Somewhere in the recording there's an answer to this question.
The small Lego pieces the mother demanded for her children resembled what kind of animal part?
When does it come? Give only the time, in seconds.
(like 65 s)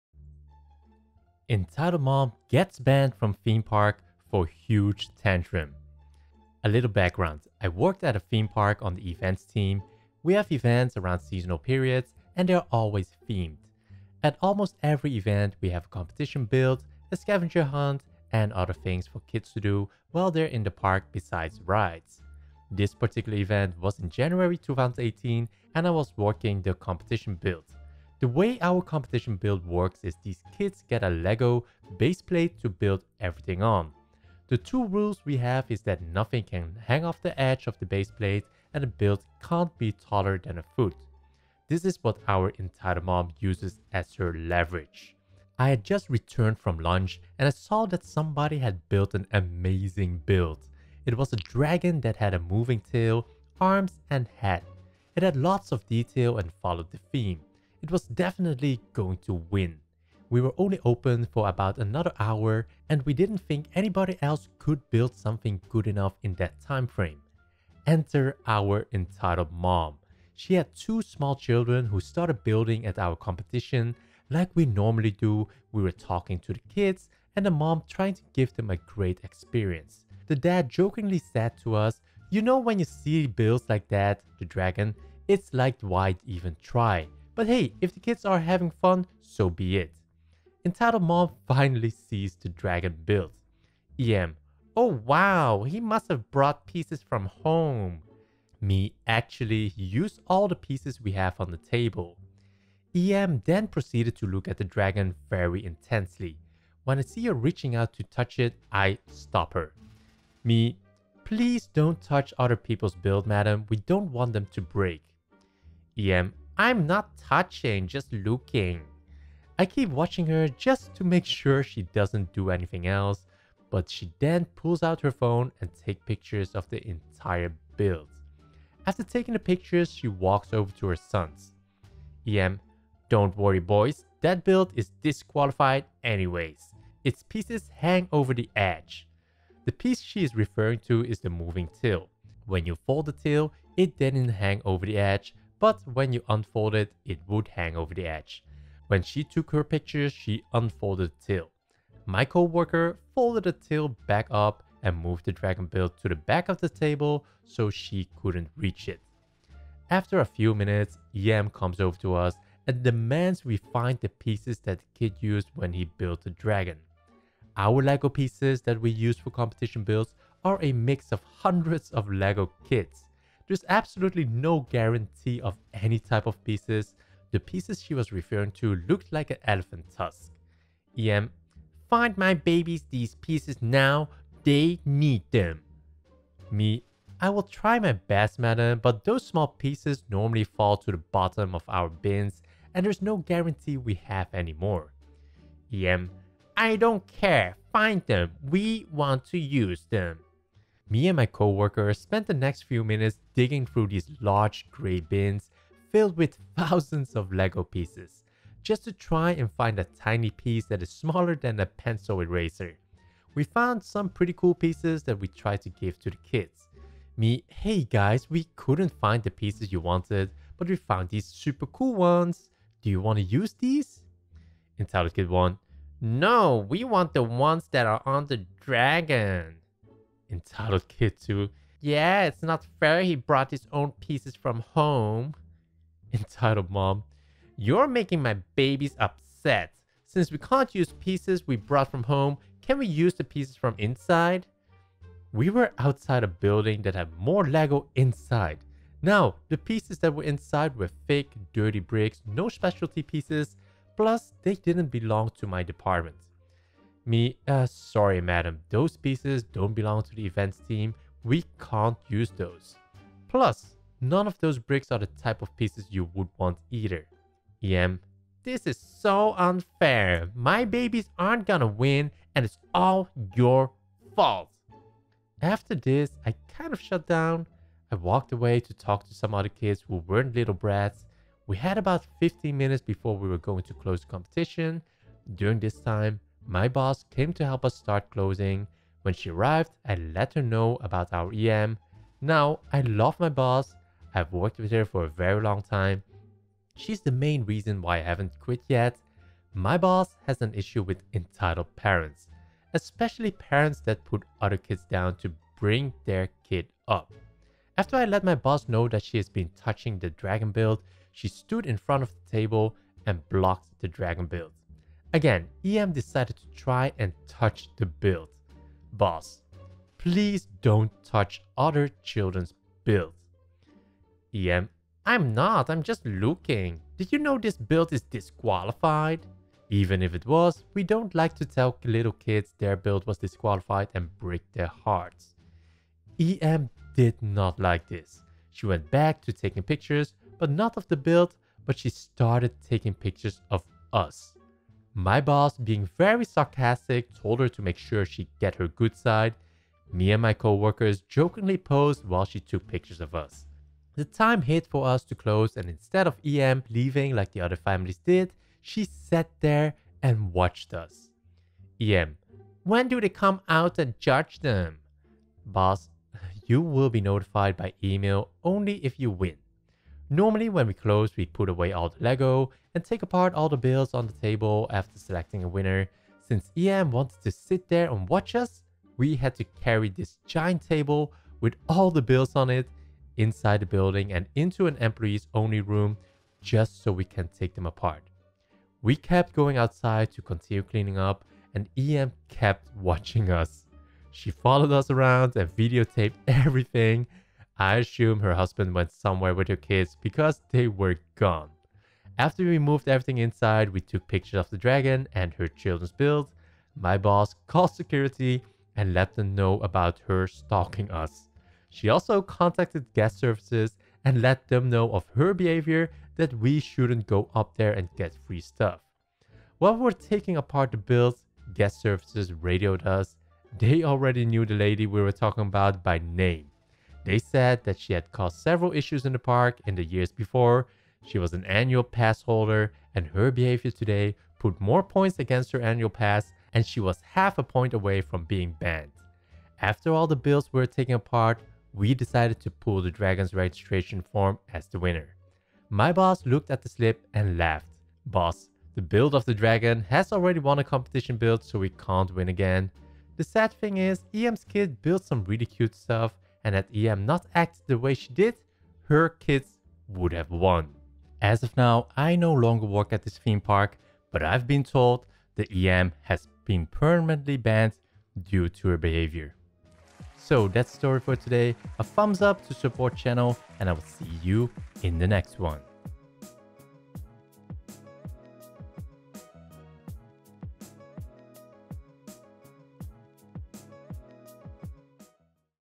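179 s.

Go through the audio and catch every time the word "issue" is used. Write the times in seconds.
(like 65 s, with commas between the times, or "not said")
300 s, 428 s.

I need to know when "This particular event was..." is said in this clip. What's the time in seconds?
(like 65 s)
22 s.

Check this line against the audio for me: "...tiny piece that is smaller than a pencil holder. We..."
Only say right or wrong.
wrong.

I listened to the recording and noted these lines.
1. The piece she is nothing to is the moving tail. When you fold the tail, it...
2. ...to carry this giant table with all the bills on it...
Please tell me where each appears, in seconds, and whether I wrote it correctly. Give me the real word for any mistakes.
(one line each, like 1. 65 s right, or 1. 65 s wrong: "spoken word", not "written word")
1. 139 s wrong: "referring", not "nothing"
2. 379 s right.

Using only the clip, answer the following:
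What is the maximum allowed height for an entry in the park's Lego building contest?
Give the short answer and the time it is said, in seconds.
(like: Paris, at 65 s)
a foot, at 40 s.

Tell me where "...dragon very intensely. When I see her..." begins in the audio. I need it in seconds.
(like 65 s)
104 s.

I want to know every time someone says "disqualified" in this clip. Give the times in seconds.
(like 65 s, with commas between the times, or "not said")
135 s, 328 s, 333 s.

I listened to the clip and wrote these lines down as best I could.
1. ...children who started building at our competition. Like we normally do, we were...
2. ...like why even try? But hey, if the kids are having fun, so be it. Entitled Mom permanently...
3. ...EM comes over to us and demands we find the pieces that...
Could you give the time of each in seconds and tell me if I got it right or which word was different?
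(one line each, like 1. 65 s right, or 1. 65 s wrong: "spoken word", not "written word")
1. 71 s right
2. 85 s wrong: "finally", not "permanently"
3. 161 s right.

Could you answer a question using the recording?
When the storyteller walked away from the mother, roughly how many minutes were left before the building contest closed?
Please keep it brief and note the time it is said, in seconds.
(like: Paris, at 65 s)
15, at 282 s.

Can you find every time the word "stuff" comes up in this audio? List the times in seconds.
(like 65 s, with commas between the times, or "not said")
418 s, 455 s.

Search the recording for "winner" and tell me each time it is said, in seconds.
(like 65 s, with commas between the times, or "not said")
375 s, 444 s.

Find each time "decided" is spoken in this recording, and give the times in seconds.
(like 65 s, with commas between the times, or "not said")
315 s, 441 s.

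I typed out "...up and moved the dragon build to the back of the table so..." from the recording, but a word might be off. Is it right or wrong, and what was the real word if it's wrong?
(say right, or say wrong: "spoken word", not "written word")
right.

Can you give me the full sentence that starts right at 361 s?
EM, when do they come out and judge them?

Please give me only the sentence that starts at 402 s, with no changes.
After we moved everything inside, we took pictures of the dragon and her children's build.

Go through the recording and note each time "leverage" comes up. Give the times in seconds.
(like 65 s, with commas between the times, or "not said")
44 s.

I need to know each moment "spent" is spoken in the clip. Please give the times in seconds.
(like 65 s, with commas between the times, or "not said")
201 s.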